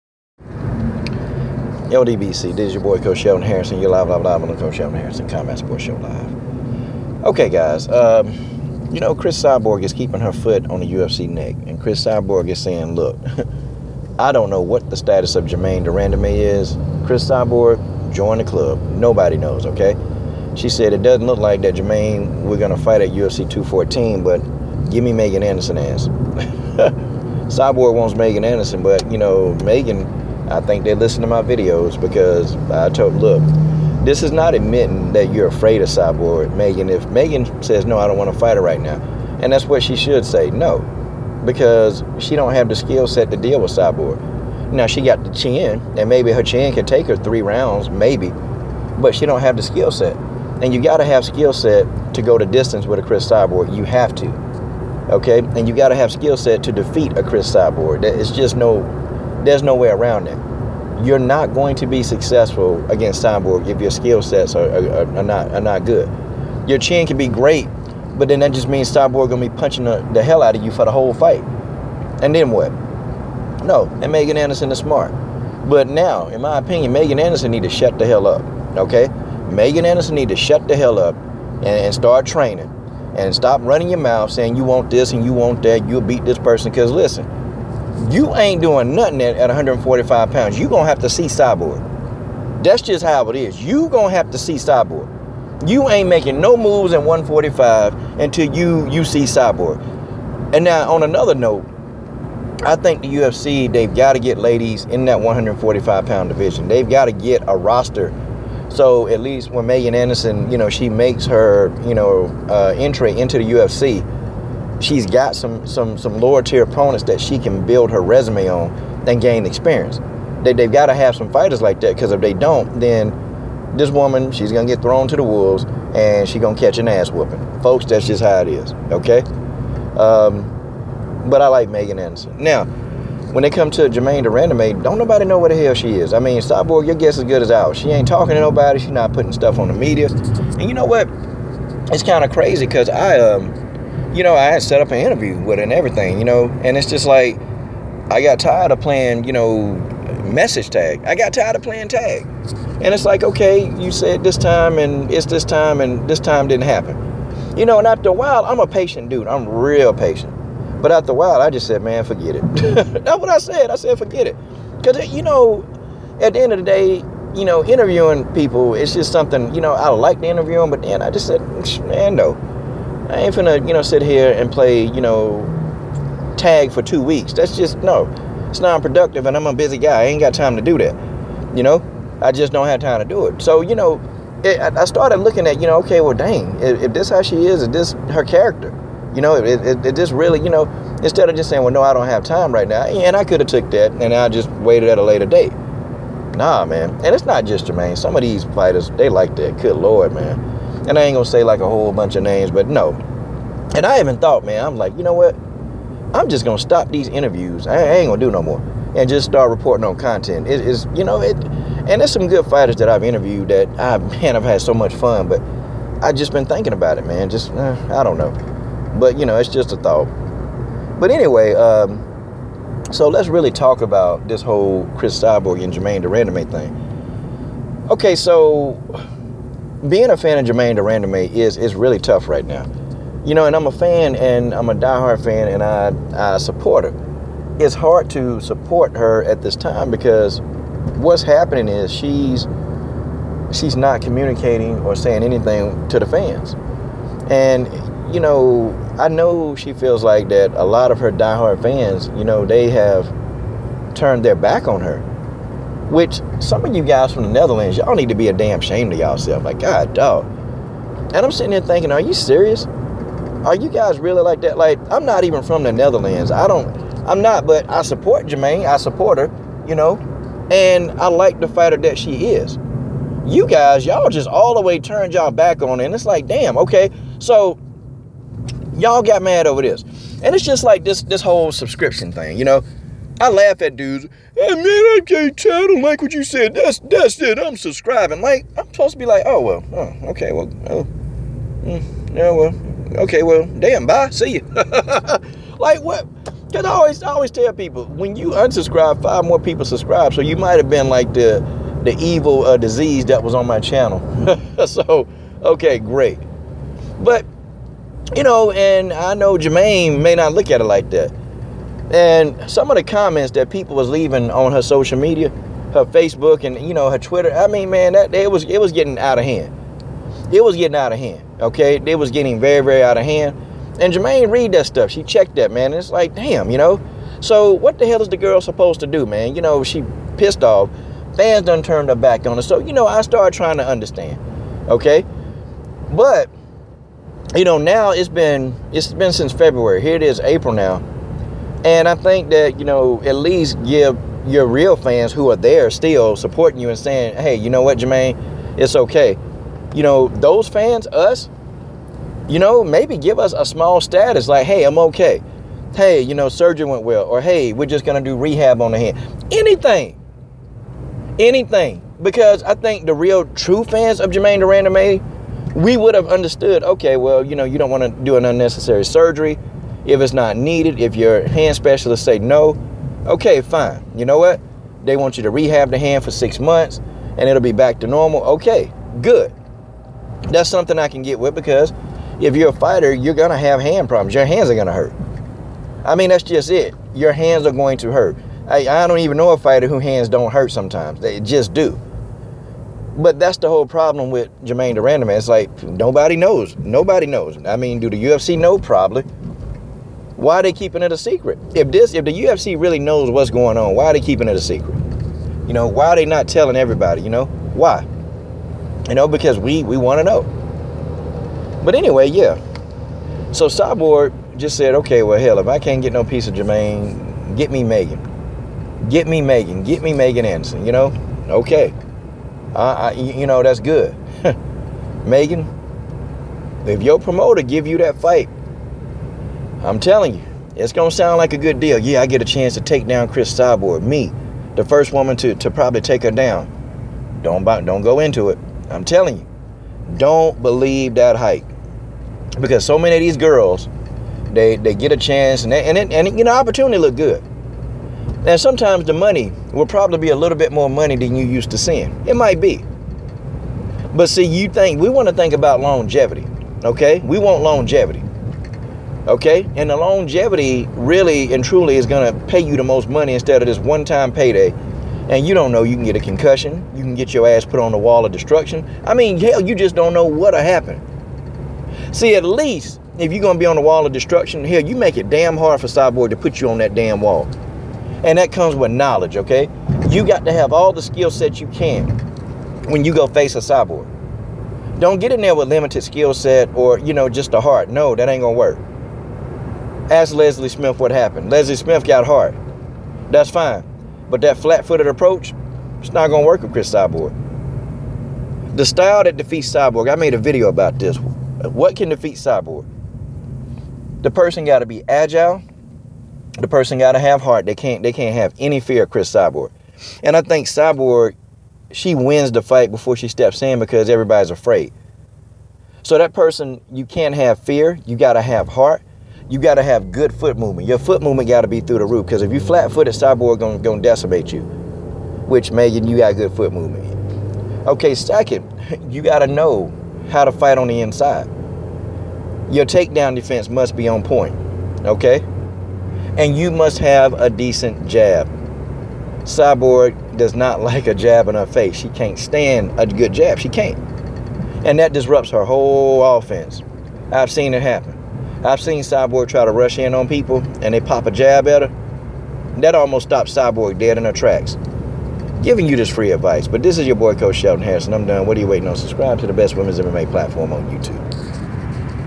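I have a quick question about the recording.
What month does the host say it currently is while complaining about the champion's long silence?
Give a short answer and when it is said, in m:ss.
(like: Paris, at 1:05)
April, at 5:40.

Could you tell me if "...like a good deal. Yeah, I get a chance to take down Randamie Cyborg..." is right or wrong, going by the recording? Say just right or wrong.
wrong.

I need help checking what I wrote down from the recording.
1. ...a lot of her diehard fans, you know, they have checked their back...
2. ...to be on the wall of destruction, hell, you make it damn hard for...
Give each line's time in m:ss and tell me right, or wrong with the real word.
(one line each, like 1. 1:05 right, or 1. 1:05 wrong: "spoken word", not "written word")
1. 4:10 wrong: "turned", not "checked"
2. 7:53 right.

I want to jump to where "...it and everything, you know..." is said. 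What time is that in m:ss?
2:25.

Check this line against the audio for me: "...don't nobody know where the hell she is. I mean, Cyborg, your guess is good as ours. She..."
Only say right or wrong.
right.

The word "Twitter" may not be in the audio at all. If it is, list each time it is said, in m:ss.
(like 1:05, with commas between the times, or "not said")
5:16.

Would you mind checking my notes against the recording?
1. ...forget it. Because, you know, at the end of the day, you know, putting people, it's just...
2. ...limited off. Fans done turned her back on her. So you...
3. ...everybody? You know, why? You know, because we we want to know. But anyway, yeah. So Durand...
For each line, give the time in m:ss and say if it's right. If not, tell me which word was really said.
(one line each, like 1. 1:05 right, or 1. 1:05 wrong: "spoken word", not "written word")
1. 2:43 wrong: "interviewing", not "putting"
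2. 5:30 wrong: "pissed", not "limited"
3. 6:46 wrong: "Cyborg", not "Durand".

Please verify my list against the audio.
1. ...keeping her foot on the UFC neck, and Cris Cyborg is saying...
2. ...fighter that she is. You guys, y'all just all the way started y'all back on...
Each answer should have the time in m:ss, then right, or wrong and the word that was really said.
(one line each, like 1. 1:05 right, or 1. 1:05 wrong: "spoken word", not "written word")
1. 0:09 right
2. 4:31 wrong: "turned", not "started".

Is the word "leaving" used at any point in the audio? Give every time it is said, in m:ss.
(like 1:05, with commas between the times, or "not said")
5:13.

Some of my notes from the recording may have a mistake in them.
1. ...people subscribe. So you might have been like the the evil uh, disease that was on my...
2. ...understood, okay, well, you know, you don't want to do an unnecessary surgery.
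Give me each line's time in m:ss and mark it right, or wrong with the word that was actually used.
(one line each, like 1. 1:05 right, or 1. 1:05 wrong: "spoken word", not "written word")
1. 4:59 right
2. 6:06 right.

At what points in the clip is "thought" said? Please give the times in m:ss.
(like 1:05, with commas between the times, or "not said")
3:24, 3:39.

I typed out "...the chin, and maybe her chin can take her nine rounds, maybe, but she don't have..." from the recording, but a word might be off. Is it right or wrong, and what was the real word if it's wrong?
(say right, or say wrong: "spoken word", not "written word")
wrong: "three", not "nine".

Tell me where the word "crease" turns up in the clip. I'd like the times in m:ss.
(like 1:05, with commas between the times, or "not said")
not said.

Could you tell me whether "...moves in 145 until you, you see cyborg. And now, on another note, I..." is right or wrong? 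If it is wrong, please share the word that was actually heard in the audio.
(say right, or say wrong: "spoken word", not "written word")
right.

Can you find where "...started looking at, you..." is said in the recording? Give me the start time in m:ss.
3:04.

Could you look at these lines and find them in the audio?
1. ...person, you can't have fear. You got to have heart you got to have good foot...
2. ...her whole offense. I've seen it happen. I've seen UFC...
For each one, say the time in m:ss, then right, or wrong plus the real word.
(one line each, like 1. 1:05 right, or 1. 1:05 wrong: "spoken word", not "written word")
1. 8:36 right
2. 9:05 wrong: "Cyborg", not "UFC".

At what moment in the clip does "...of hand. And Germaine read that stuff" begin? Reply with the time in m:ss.
5:22.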